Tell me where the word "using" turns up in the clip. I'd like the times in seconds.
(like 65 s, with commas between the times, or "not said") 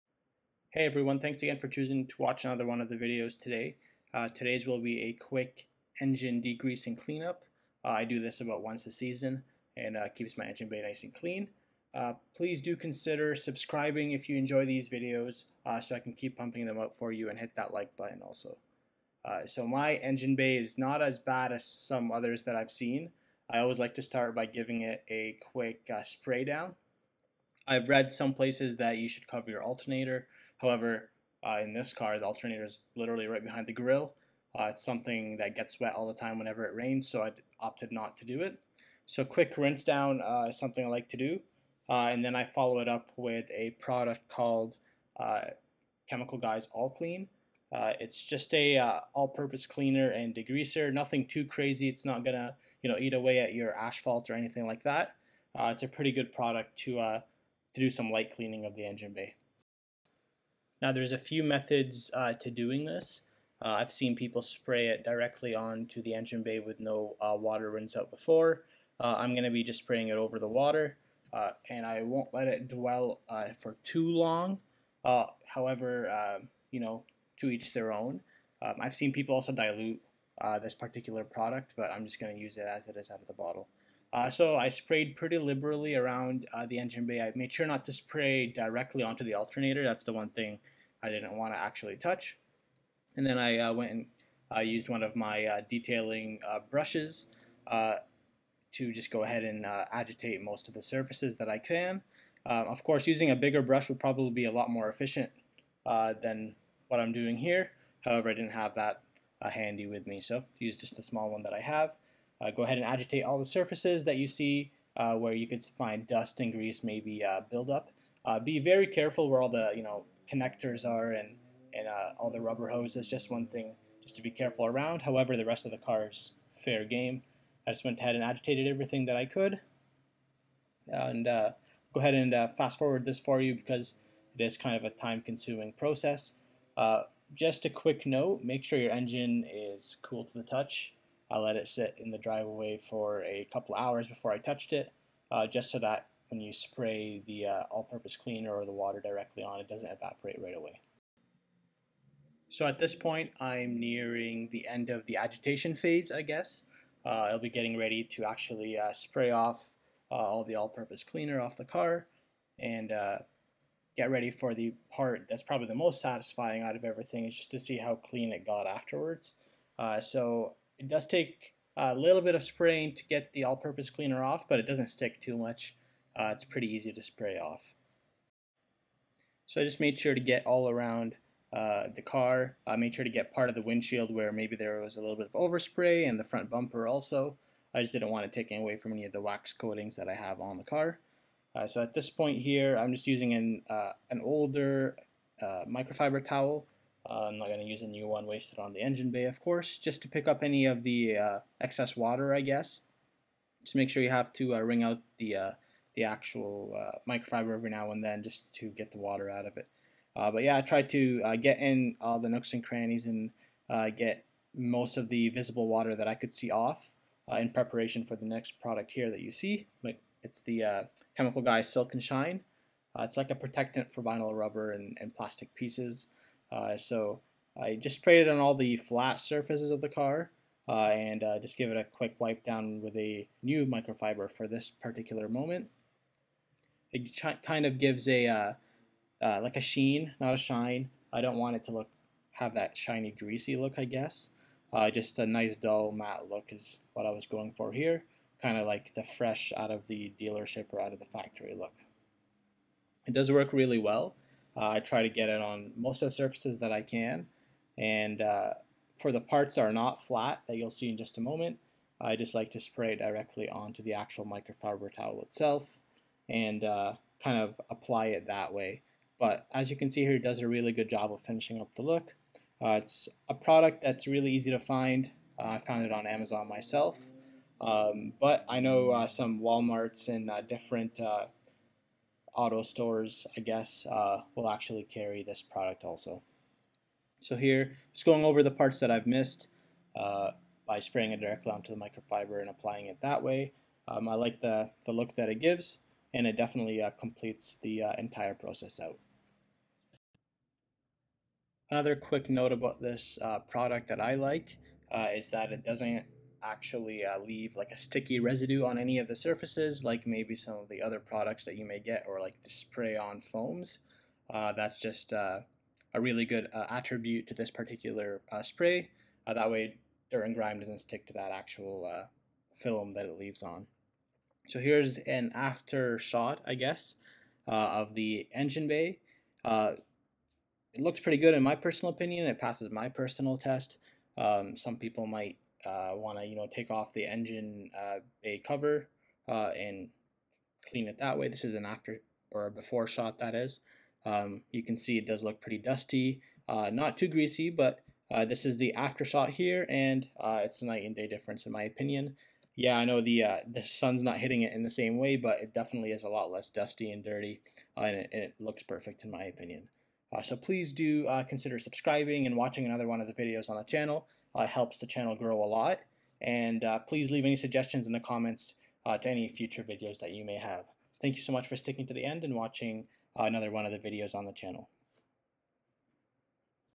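103 s, 193 s.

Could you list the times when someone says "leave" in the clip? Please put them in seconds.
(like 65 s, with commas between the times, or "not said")
307 s, 323 s, 367 s.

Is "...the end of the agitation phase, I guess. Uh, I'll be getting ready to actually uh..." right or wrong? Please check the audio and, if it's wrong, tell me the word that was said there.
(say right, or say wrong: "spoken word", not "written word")
right.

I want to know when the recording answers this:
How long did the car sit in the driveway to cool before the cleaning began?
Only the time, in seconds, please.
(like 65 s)
143 s.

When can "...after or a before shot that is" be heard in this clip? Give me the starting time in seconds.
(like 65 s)
341 s.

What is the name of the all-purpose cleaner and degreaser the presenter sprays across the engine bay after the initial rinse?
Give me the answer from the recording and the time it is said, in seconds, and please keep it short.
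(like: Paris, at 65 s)
Chemical Guys All Clean, at 46 s.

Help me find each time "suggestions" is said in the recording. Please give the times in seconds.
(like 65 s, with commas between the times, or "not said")
367 s.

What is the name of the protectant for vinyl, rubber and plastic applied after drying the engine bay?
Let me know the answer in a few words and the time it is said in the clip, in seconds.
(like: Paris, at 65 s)
Silk and Shine, at 221 s.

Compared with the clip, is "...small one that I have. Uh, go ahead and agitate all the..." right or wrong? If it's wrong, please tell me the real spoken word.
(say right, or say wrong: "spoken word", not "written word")
right.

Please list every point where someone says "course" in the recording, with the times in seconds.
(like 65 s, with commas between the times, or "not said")
102 s, 199 s.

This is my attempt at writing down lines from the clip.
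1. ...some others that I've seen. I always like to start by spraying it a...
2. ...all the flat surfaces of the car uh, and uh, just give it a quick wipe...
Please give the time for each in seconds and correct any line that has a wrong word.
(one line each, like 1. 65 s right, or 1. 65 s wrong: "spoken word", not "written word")
1. 21 s wrong: "giving", not "spraying"
2. 228 s right.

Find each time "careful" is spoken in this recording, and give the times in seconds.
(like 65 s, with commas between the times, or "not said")
118 s, 124 s.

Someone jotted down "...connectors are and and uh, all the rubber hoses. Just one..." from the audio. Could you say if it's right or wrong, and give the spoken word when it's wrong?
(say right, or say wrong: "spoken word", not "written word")
right.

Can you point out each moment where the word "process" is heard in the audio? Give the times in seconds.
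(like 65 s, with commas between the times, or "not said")
135 s, 298 s.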